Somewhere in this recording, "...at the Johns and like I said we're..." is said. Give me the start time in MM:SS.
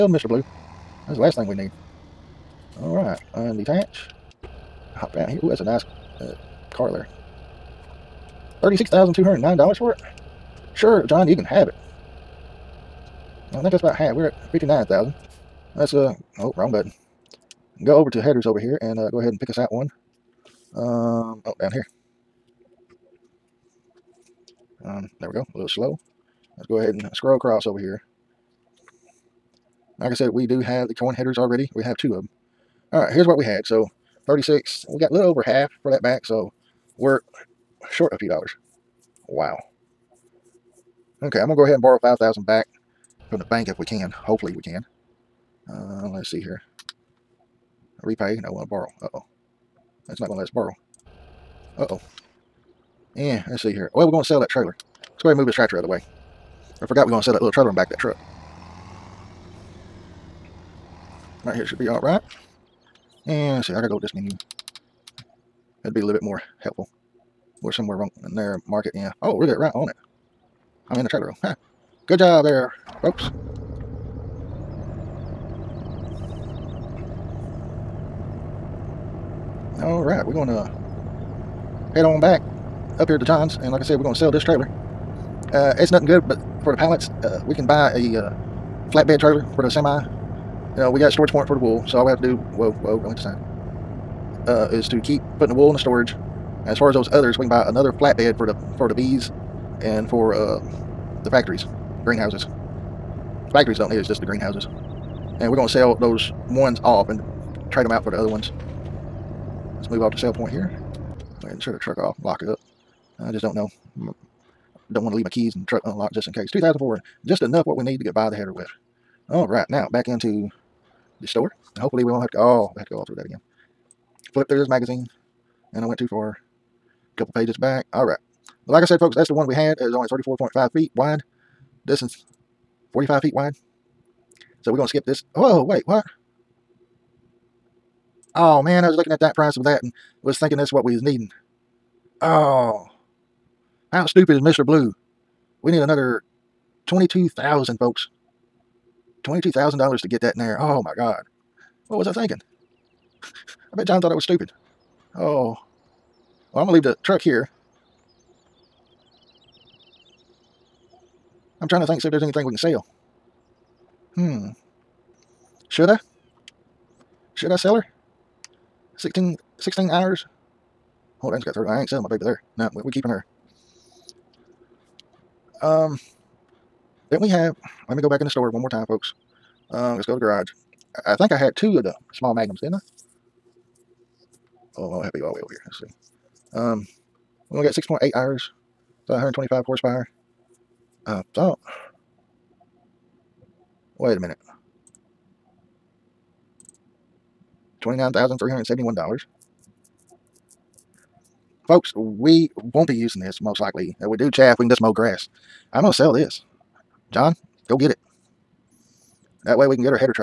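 01:23.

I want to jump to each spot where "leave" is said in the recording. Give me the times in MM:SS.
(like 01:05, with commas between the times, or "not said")
01:55, 02:36.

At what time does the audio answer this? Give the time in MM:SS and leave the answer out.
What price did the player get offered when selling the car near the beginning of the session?
00:08.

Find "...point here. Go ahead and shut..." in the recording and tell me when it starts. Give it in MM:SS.
01:50.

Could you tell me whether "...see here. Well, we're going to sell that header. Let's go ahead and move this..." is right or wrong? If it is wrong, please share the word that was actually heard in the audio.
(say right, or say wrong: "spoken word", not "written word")
wrong: "trailer", not "header".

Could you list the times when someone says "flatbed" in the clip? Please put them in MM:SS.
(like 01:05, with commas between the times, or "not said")
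01:28, 01:37.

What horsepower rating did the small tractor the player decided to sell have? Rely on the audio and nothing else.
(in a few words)
125.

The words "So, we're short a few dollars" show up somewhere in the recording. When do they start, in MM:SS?
00:36.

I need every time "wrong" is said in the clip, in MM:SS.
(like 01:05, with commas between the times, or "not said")
00:16, 01:07.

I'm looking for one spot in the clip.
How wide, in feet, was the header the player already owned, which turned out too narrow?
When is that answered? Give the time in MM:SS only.
02:10.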